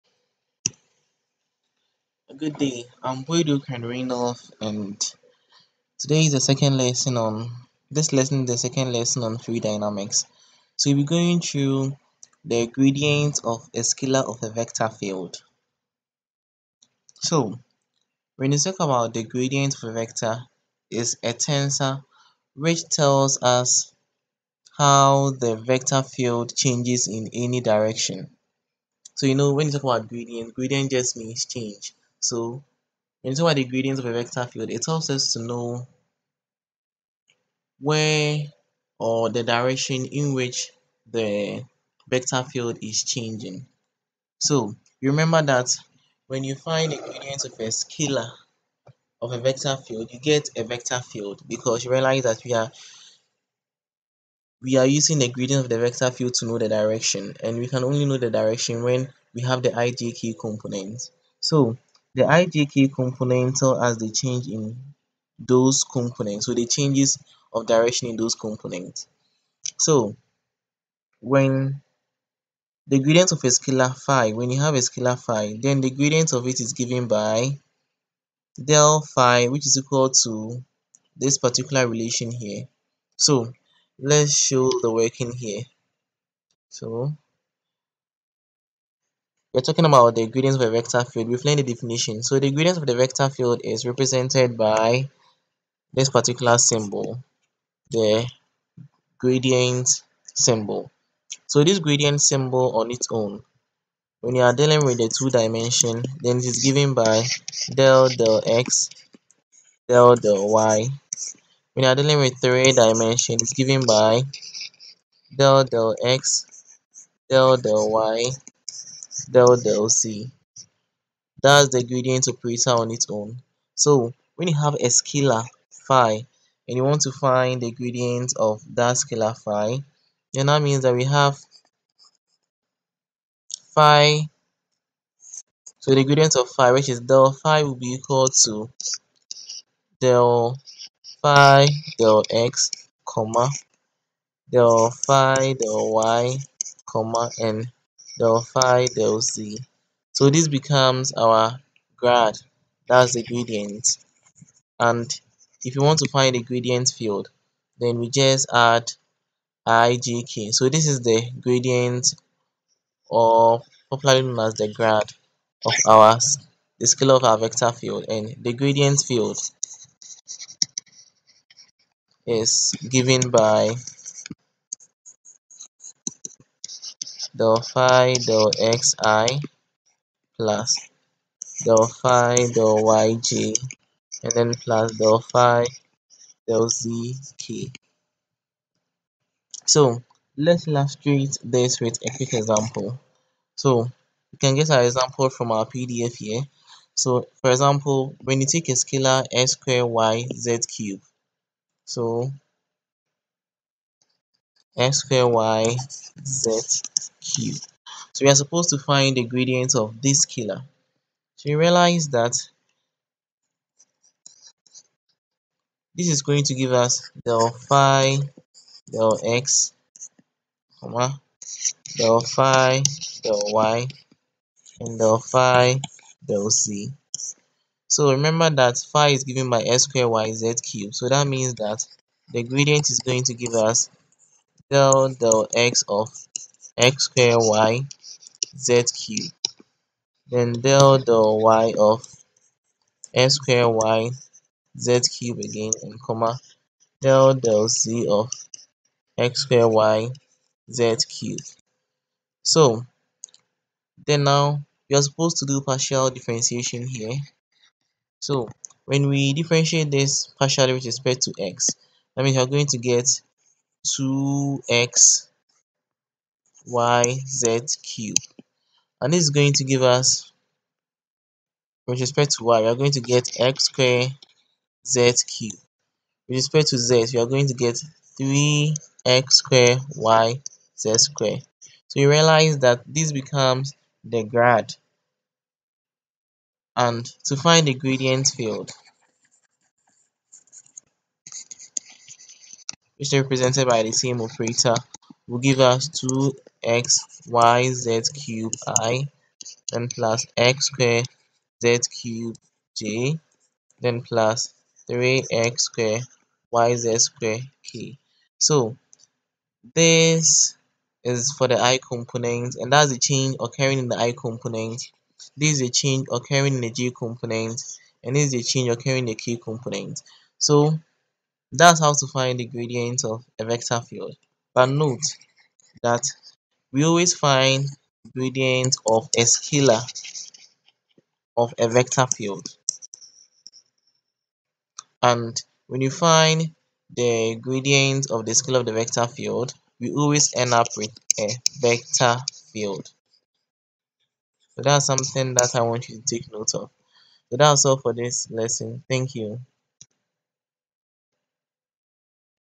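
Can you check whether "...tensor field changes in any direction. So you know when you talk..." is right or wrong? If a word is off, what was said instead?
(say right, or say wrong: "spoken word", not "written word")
wrong: "vector", not "tensor".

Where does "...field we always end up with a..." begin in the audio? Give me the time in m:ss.
5:39.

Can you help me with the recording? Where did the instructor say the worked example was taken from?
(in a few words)
our PDF.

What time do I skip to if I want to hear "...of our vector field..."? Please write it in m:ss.
2:47.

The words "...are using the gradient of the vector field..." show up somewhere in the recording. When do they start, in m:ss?
0:54.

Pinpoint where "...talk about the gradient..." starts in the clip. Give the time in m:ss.
0:18.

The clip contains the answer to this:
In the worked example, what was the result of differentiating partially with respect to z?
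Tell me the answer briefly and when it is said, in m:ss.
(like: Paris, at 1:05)
3x²yz², at 4:38.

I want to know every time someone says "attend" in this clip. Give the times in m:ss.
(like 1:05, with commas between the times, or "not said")
not said.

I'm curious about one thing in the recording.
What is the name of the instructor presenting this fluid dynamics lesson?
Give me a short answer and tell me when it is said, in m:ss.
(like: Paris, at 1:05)
Boadu, at 0:03.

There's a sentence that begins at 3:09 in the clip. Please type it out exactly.
So let's illustrate this with a quick example.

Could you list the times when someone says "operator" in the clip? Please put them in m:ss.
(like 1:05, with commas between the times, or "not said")
2:02, 4:54.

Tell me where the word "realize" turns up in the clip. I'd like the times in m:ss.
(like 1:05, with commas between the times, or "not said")
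0:51, 3:31, 4:42.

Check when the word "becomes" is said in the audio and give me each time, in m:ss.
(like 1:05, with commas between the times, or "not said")
2:30, 4:43.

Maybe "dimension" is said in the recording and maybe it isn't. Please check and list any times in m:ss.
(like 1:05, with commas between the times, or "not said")
1:45, 1:52.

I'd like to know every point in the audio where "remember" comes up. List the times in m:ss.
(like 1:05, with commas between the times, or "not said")
0:45, 3:48.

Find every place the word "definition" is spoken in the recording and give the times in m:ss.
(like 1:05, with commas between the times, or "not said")
1:31.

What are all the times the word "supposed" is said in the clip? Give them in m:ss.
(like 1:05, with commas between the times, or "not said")
3:28, 4:15.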